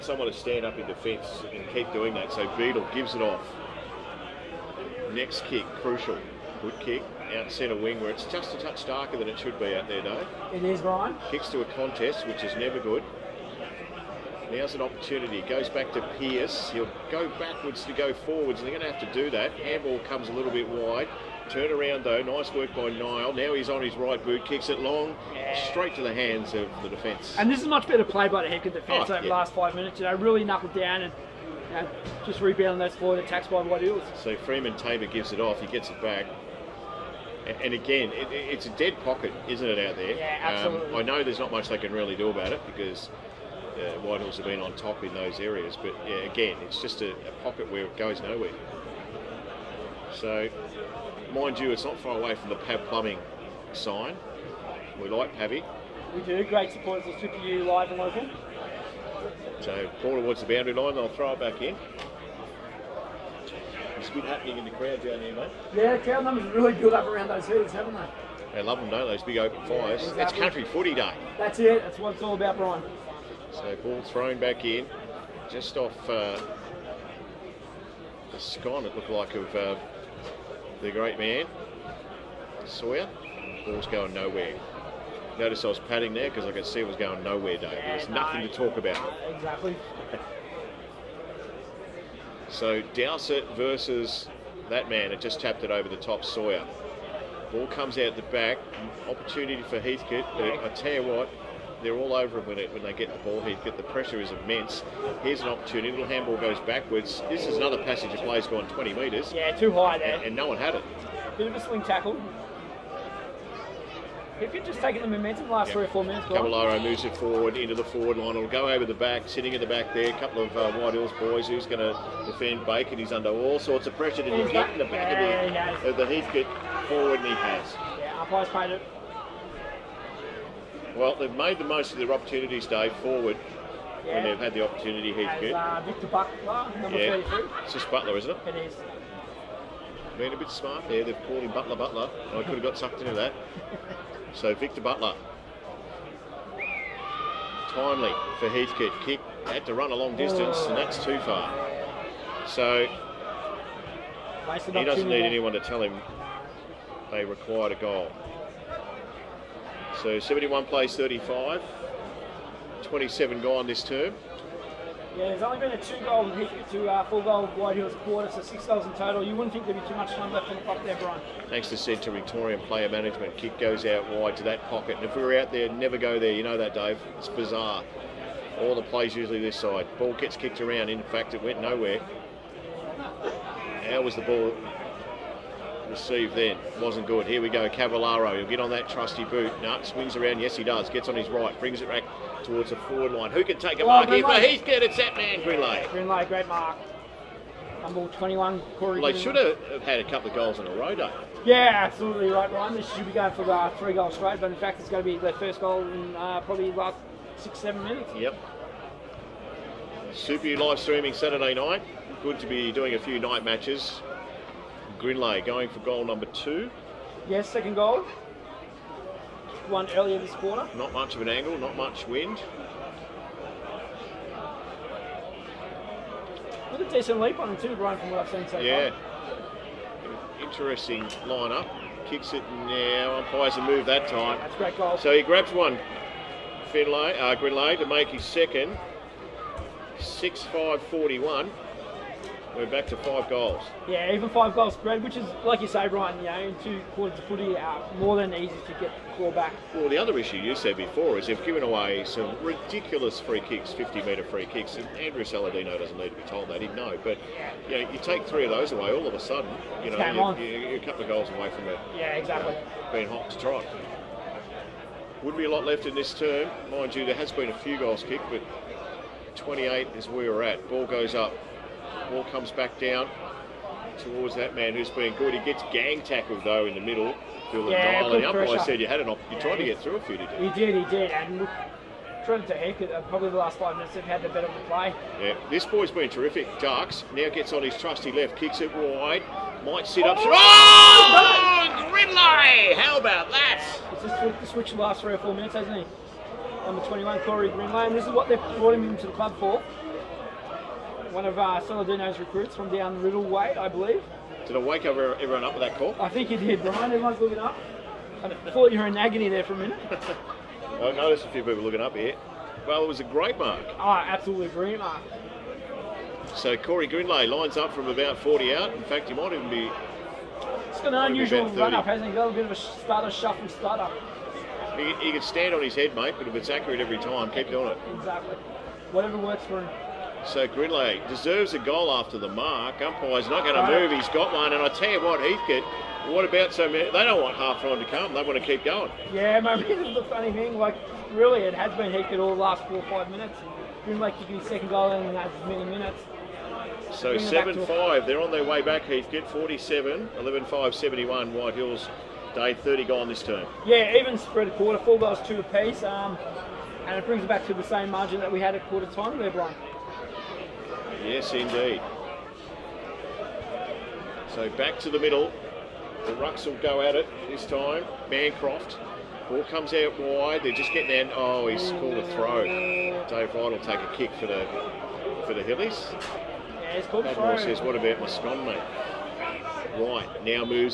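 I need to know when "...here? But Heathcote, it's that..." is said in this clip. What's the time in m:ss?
3:14.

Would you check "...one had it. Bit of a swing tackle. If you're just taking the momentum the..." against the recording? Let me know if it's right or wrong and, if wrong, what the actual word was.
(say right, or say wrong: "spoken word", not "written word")
right.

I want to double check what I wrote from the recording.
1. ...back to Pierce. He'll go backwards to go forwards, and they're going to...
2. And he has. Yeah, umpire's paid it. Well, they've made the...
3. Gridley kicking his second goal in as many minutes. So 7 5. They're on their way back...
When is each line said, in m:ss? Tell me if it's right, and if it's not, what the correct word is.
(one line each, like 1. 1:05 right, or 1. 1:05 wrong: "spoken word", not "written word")
1. 0:15 right
2. 2:07 right
3. 5:43 right.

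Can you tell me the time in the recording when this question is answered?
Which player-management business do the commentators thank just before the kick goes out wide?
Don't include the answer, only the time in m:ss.
2:52.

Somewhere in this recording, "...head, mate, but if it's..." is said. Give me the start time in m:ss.
5:25.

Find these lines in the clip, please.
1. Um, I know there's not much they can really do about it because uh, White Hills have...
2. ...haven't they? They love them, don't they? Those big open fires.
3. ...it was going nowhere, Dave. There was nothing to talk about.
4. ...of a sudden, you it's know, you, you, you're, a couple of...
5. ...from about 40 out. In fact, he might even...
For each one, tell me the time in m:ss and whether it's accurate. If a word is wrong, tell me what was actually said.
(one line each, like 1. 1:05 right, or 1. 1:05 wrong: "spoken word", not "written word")
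1. 0:40 right
2. 1:07 right
3. 1:26 right
4. 4:19 right
5. 5:17 right.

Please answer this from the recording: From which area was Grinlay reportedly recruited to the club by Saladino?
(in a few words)
Riddell.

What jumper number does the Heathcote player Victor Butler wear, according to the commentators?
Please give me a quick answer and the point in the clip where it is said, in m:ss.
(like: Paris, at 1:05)
33, at 2:17.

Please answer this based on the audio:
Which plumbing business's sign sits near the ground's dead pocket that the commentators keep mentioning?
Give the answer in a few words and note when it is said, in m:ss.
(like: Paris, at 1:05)
Pav Plumbing, at 0:52.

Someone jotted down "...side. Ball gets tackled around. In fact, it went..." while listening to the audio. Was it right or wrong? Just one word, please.
wrong.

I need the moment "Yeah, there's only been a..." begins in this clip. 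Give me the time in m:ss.
2:45.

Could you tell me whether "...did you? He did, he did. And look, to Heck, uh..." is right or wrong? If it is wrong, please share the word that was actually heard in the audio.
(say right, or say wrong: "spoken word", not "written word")
right.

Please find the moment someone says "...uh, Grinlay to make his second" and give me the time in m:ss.
3:57.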